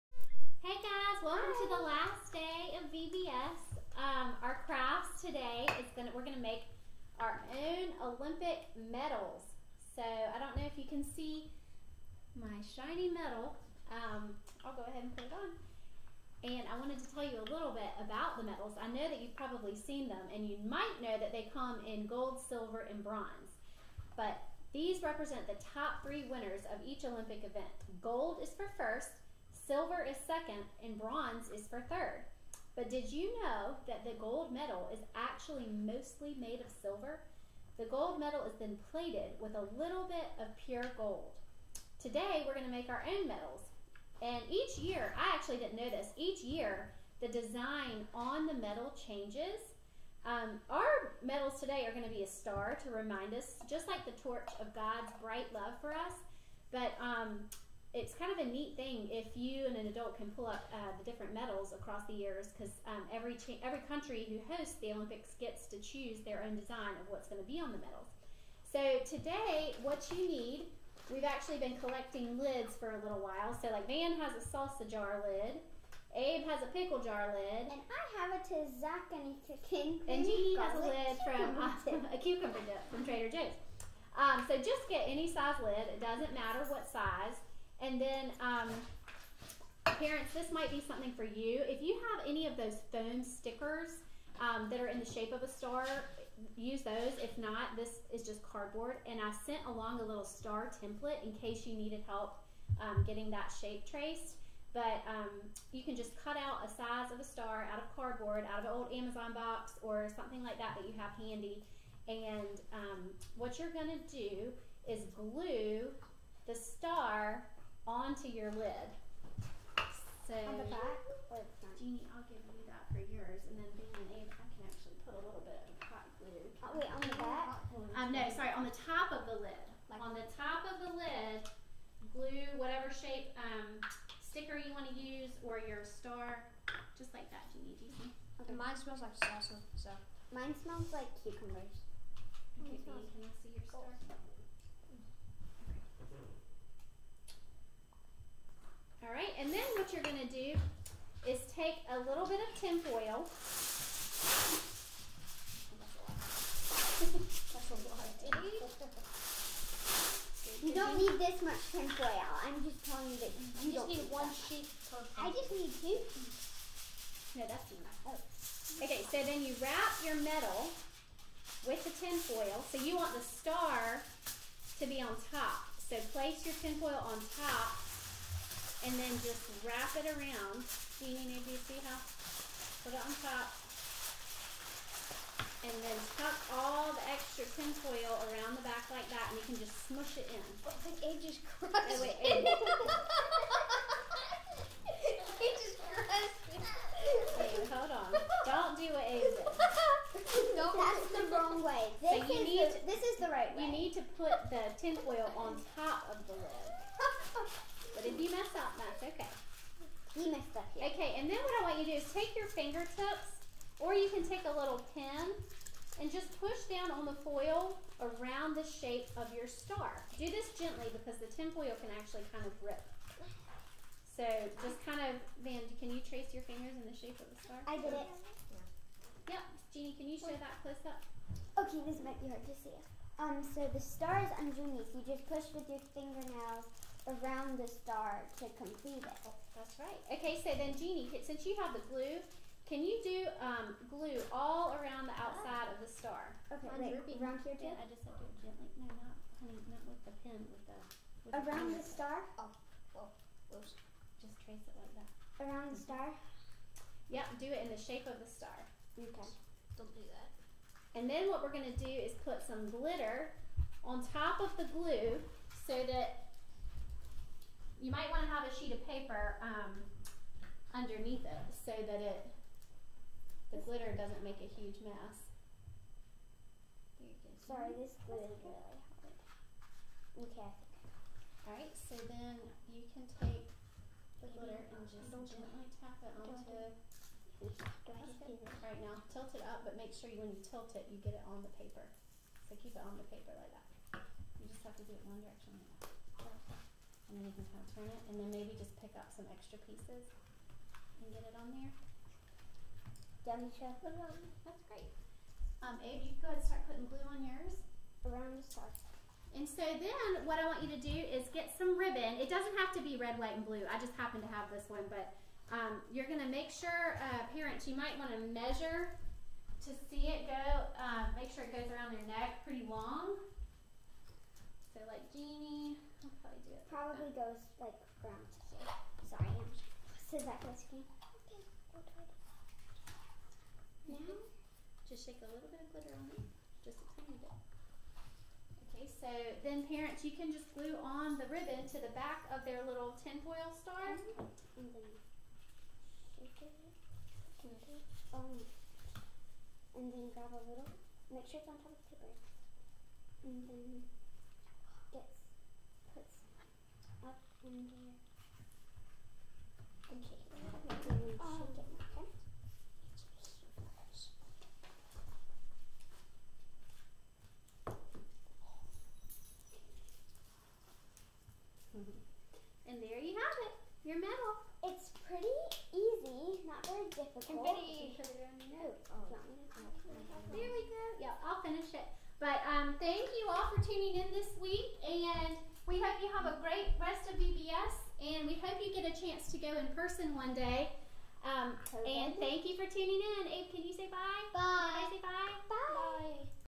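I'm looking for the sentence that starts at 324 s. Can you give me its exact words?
So like Jeannie, probably do it.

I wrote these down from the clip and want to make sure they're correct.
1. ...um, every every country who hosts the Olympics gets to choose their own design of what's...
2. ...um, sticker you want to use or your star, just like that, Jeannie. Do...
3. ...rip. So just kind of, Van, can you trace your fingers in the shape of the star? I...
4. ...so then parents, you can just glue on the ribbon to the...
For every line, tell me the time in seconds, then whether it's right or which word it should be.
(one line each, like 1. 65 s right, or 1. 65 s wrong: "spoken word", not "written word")
1. 62 s right
2. 133 s right
3. 222 s right
4. 338 s right.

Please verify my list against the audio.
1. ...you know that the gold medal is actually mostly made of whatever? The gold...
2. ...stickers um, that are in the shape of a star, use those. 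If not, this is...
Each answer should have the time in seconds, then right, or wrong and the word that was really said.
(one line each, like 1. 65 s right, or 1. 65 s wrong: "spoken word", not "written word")
1. 33 s wrong: "silver", not "whatever"
2. 93 s right.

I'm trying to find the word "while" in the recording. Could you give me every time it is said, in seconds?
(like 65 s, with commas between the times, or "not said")
73 s.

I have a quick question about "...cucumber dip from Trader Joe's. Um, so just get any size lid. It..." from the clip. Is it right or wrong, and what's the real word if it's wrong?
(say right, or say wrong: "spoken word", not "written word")
right.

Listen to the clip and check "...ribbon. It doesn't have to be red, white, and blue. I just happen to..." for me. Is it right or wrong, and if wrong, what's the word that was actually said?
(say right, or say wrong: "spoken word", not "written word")
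right.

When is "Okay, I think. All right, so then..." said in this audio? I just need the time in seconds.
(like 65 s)
279 s.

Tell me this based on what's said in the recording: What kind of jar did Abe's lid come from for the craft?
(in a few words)
pickle jar.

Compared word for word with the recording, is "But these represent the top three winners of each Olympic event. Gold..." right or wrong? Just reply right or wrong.
right.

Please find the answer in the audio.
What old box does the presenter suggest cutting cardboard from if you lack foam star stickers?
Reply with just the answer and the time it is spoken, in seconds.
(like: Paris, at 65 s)
Amazon box, at 108 s.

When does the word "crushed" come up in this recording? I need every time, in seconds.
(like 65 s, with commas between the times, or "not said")
191 s.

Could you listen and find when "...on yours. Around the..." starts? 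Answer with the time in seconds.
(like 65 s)
307 s.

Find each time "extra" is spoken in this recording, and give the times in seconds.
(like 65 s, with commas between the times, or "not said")
187 s, 299 s.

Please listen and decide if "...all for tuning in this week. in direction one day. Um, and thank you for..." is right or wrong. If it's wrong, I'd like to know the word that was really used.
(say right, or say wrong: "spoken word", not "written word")
wrong: "person", not "direction".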